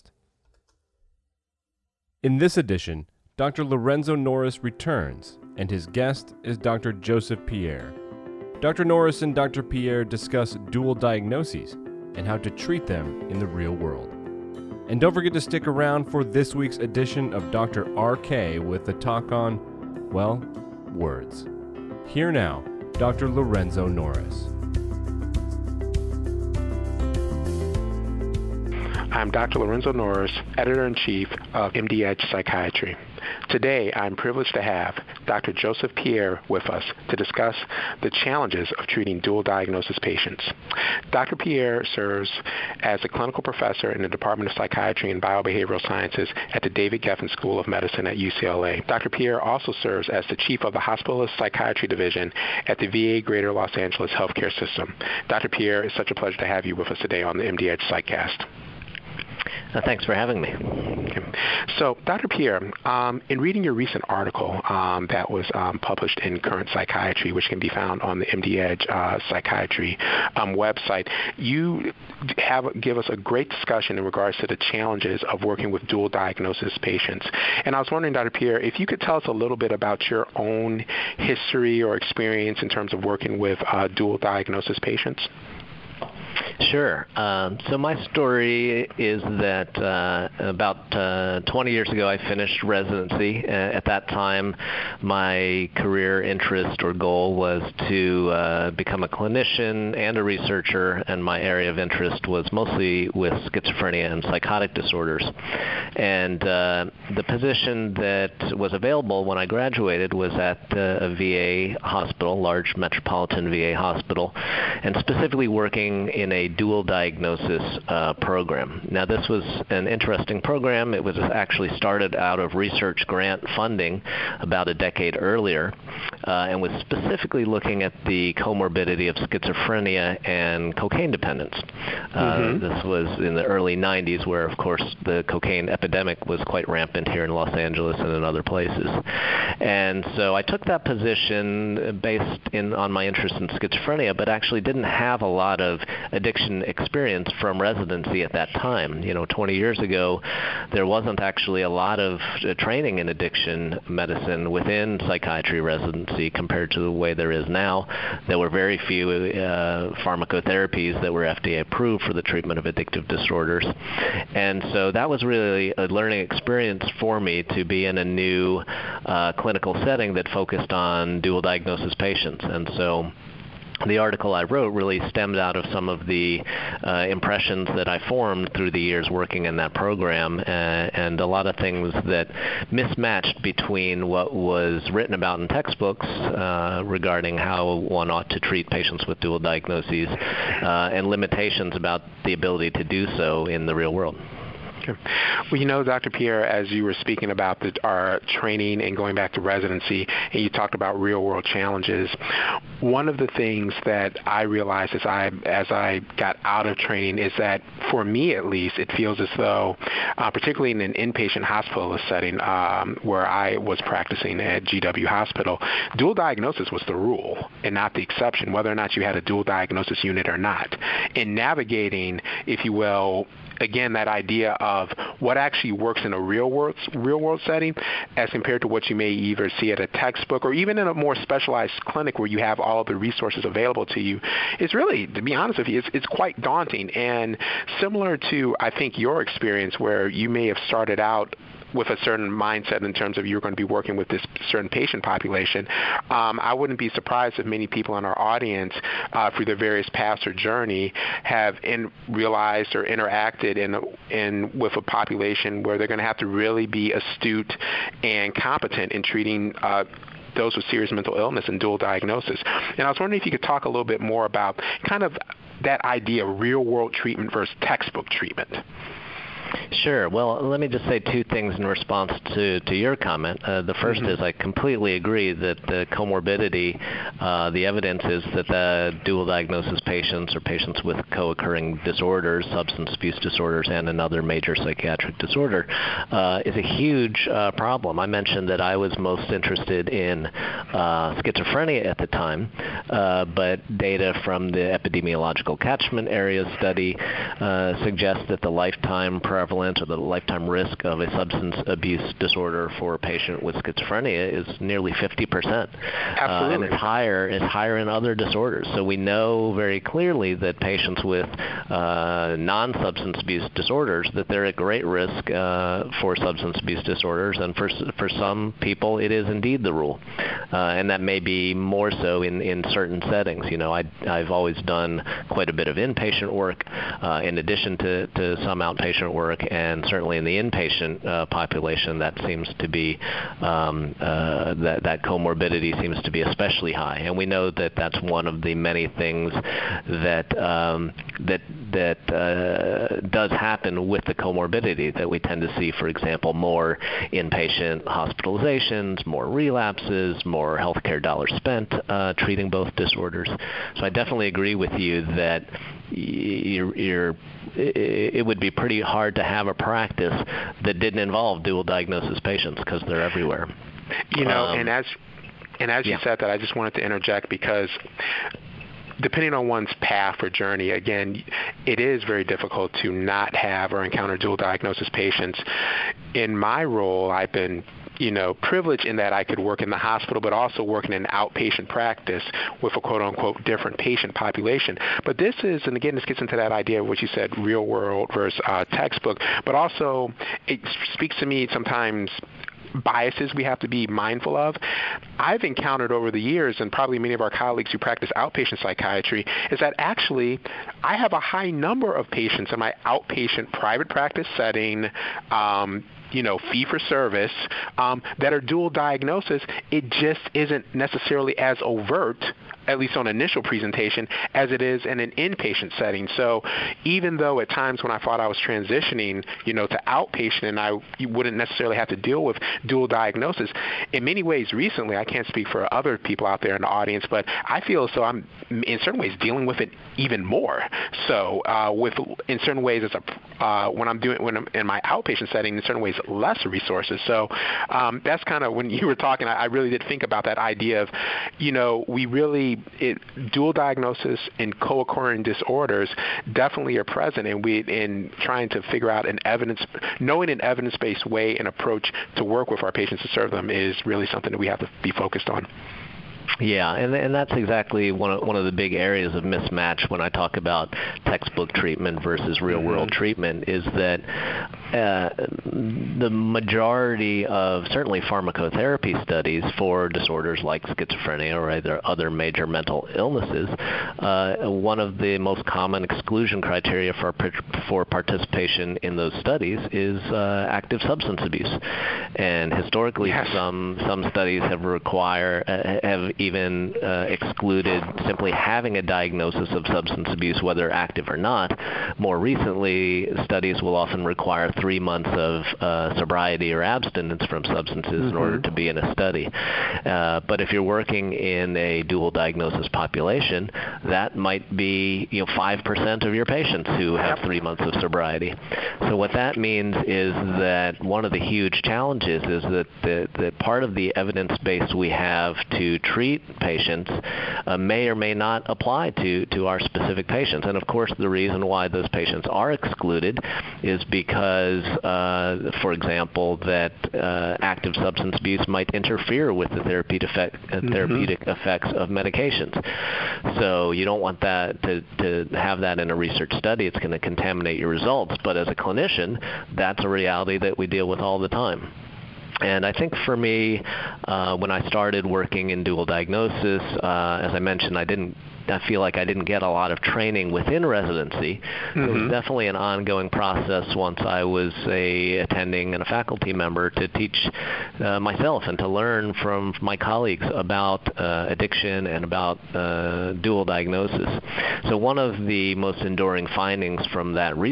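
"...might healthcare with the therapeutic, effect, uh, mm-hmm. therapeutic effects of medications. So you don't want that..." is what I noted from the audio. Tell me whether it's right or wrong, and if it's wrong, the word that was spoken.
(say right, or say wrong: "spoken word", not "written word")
wrong: "interfere", not "healthcare".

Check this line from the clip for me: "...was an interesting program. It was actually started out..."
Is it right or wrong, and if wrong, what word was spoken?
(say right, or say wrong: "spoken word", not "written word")
right.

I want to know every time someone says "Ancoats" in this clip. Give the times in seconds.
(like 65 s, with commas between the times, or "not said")
not said.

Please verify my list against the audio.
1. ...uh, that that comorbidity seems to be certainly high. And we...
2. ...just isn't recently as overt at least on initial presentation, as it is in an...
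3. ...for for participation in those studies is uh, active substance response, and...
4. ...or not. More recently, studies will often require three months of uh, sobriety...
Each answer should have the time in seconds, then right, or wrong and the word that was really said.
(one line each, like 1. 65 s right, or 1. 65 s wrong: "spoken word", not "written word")
1. 333 s wrong: "especially", not "certainly"
2. 409 s wrong: "necessarily", not "recently"
3. 477 s wrong: "abuse", not "response"
4. 491 s right.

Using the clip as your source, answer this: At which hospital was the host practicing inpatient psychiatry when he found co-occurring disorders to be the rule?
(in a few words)
GW Hospital.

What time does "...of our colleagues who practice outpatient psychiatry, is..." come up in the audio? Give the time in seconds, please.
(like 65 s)
397 s.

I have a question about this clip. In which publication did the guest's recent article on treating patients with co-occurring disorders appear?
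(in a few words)
Current Psychiatry.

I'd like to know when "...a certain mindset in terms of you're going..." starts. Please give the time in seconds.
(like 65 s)
241 s.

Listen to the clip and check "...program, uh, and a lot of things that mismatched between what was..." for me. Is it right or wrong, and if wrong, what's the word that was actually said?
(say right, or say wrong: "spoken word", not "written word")
right.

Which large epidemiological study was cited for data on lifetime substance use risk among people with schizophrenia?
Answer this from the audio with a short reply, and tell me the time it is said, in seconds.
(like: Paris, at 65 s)
Epidemiological Catchment Area study, at 294 s.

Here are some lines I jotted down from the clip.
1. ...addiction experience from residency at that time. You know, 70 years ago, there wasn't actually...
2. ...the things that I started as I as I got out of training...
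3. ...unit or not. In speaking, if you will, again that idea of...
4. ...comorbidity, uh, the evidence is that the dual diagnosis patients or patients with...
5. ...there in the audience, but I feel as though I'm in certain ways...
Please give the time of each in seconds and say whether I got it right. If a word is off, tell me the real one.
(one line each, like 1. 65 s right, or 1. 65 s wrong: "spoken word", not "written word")
1. 146 s wrong: "20", not "70"
2. 203 s wrong: "realized", not "started"
3. 220 s wrong: "navigating", not "speaking"
4. 275 s right
5. 426 s right.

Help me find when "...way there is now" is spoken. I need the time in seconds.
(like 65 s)
156 s.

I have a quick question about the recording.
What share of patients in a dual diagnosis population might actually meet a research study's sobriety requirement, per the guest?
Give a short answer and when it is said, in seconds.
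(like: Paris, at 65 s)
5%, at 505 s.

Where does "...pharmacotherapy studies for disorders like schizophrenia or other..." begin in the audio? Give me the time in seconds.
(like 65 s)
468 s.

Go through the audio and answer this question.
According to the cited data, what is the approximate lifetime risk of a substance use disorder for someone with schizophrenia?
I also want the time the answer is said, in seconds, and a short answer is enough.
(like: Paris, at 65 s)
nearly 50%, at 304 s.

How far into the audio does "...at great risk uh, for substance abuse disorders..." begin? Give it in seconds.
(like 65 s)
314 s.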